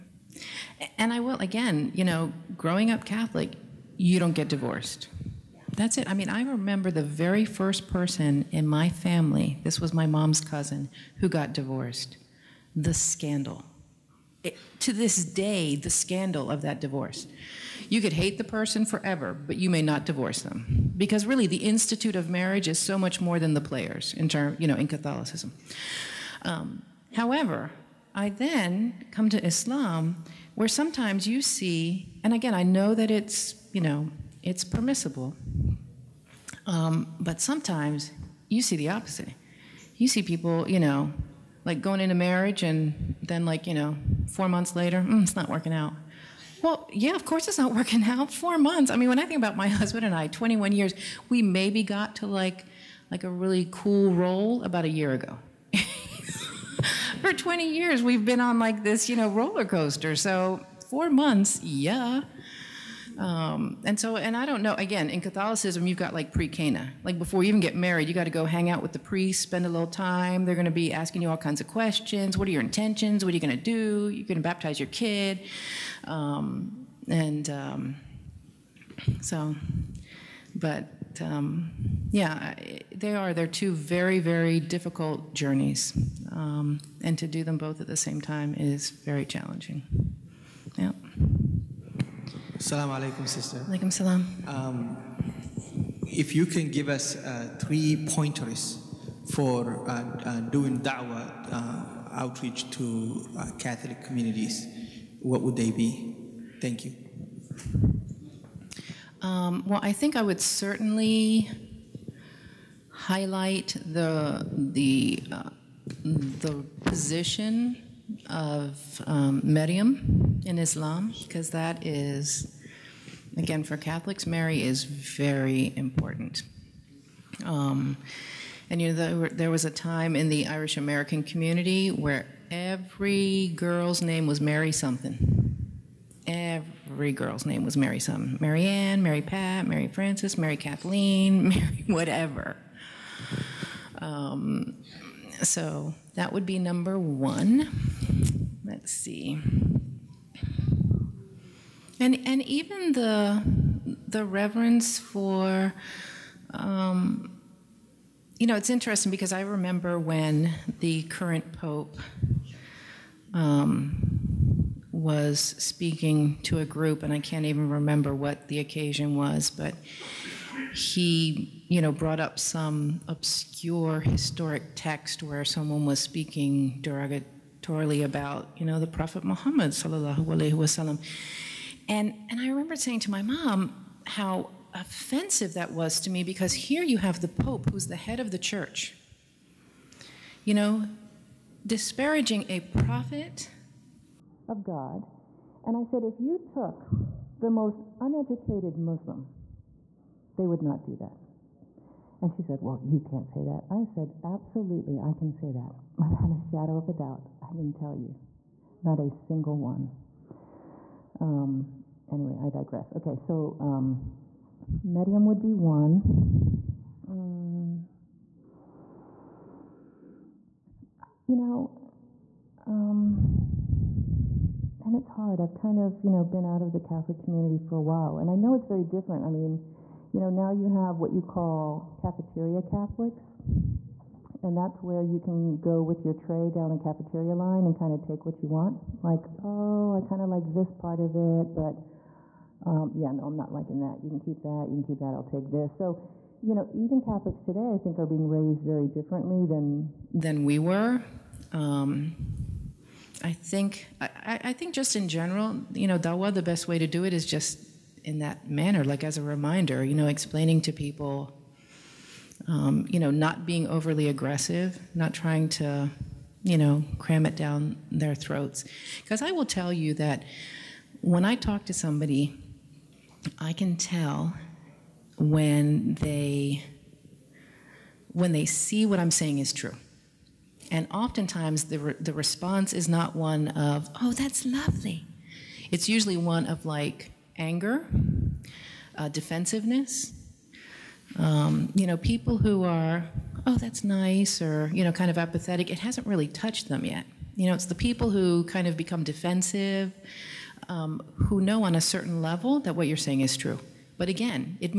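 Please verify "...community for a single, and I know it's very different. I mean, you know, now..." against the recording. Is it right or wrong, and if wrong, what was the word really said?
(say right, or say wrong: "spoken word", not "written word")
wrong: "while", not "single".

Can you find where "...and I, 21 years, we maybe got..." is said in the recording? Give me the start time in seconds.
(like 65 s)
50 s.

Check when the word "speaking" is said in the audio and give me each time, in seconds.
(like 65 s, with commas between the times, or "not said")
165 s, 176 s.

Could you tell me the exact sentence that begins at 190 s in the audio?
You know, disparaging a prophet of God.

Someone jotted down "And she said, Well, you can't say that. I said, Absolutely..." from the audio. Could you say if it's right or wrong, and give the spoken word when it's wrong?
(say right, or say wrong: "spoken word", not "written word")
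right.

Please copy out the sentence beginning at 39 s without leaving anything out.
You see people, you know, like going into marriage and then, like, you know, four months later, mm, it's not working out.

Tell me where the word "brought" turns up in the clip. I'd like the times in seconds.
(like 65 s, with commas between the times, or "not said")
171 s.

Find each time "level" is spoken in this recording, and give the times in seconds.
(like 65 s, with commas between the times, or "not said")
302 s.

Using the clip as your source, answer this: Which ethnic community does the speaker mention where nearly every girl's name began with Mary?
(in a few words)
Irish American.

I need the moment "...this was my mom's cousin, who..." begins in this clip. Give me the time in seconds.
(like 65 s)
9 s.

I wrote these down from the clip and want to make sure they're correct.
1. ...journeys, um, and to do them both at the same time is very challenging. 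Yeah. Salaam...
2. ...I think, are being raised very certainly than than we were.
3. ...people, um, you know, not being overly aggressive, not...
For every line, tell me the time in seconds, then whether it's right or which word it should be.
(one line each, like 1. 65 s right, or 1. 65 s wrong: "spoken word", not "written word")
1. 85 s right
2. 247 s wrong: "differently", not "certainly"
3. 260 s right.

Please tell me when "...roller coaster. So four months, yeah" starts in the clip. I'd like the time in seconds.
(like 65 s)
59 s.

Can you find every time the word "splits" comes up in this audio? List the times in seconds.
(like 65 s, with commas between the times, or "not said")
not said.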